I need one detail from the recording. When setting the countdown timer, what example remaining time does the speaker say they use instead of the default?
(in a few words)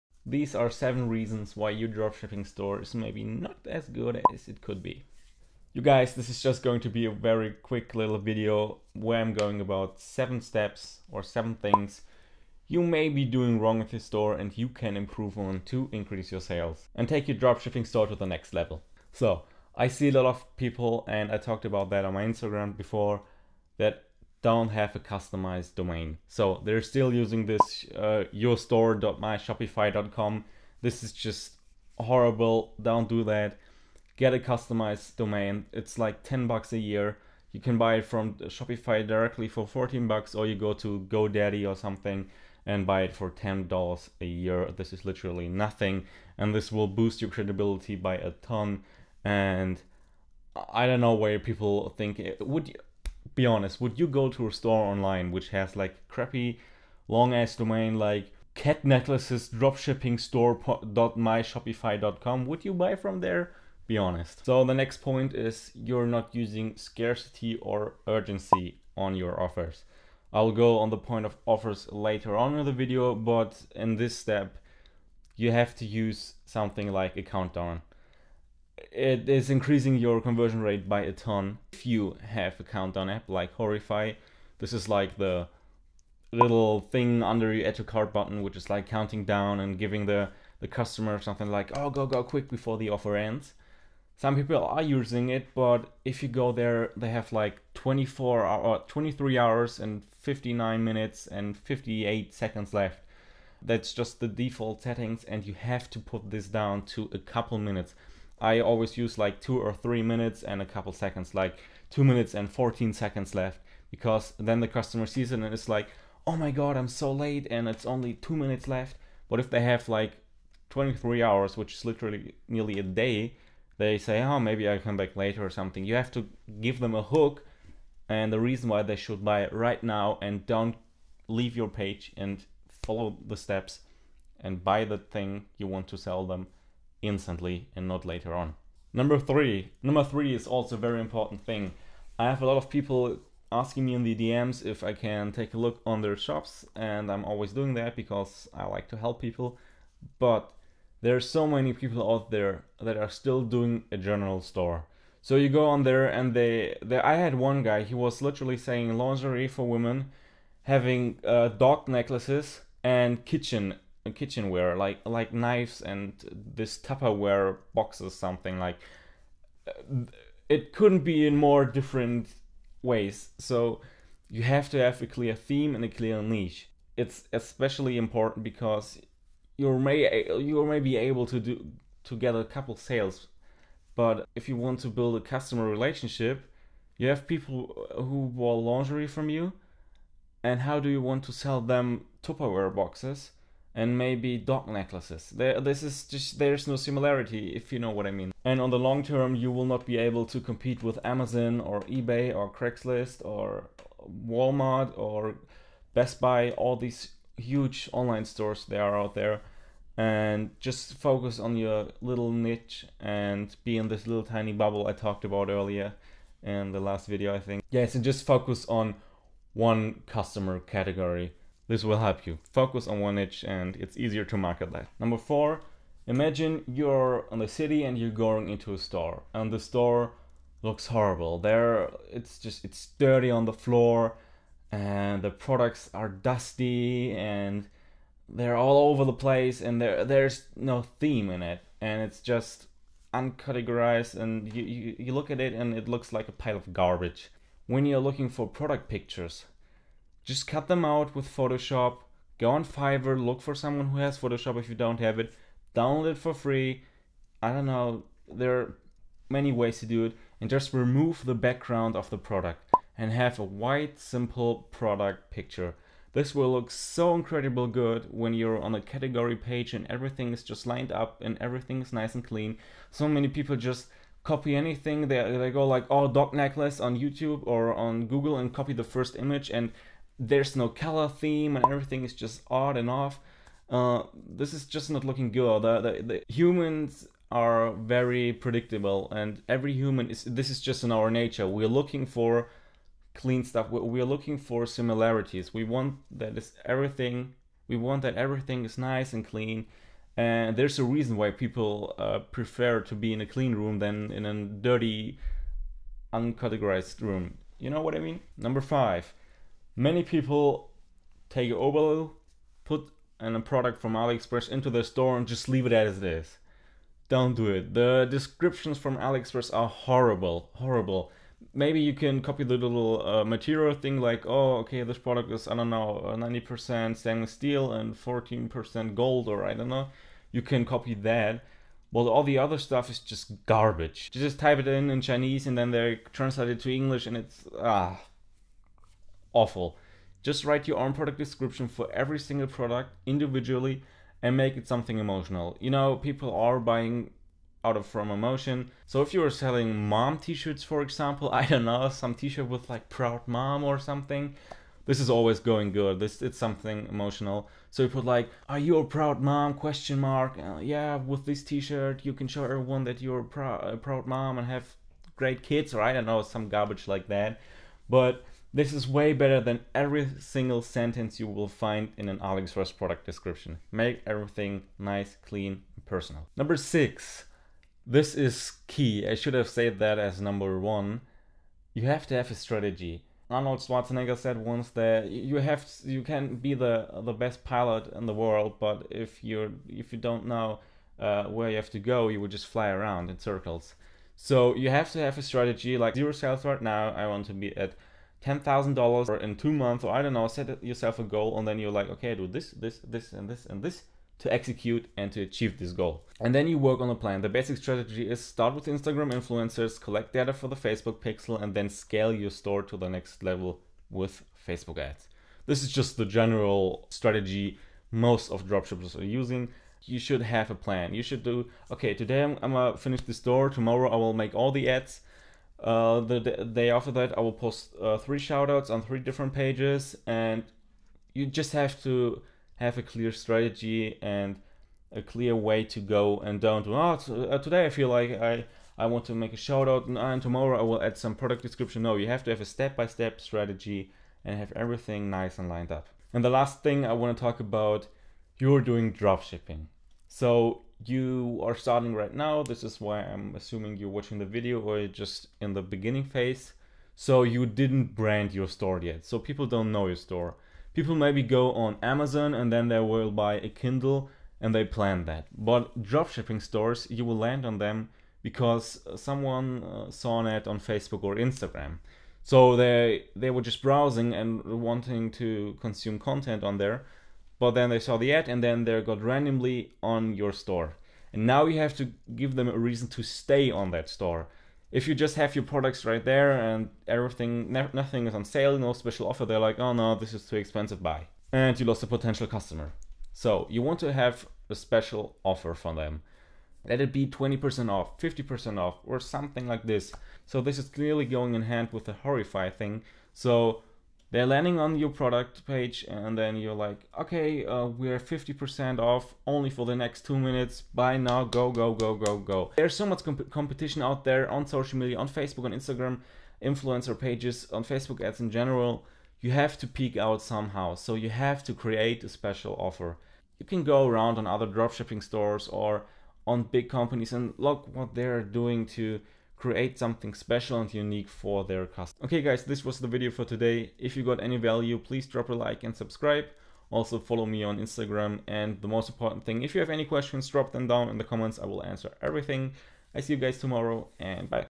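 2 minutes and 14 seconds.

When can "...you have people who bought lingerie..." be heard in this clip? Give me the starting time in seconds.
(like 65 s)
186 s.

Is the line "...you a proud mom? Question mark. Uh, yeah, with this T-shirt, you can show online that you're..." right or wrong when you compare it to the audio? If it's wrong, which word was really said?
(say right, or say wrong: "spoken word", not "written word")
wrong: "everyone", not "online".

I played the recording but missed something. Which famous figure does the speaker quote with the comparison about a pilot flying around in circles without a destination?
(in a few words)
Arnold Schwarzenegger.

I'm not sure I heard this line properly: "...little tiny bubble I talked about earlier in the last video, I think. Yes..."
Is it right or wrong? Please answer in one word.
right.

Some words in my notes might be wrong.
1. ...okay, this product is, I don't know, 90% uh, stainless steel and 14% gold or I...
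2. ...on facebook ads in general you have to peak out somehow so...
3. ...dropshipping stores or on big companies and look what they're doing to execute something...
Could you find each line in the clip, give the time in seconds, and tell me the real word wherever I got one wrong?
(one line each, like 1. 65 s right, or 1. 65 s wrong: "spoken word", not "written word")
1. 324 s right
2. 517 s right
3. 524 s wrong: "create", not "execute".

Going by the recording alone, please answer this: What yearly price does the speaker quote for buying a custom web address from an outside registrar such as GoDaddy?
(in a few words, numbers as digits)
$10.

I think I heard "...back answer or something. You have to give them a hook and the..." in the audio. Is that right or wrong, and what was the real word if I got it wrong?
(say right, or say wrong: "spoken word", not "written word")
wrong: "later", not "answer".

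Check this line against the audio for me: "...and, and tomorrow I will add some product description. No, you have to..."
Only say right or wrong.
right.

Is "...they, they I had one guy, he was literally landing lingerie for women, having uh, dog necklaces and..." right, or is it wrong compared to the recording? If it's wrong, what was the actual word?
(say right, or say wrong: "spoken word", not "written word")
wrong: "saying", not "landing".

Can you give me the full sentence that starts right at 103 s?
That's just the default settings, and you have to put this down to a couple minutes.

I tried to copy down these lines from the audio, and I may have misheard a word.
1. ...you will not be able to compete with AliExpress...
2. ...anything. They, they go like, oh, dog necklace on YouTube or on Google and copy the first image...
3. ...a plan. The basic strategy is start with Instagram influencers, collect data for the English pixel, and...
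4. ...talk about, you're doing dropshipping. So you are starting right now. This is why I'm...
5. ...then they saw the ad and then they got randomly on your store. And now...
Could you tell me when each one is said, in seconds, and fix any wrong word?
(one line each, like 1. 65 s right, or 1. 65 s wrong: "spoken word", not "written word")
1. 199 s wrong: "Amazon", not "AliExpress"
2. 274 s right
3. 406 s wrong: "Facebook", not "English"
4. 447 s right
5. 477 s right.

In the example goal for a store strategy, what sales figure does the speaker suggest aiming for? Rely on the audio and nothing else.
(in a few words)
$10,000.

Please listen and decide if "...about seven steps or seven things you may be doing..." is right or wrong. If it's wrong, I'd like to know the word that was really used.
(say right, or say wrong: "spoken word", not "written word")
right.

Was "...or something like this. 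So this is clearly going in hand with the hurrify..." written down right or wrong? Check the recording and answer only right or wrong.
right.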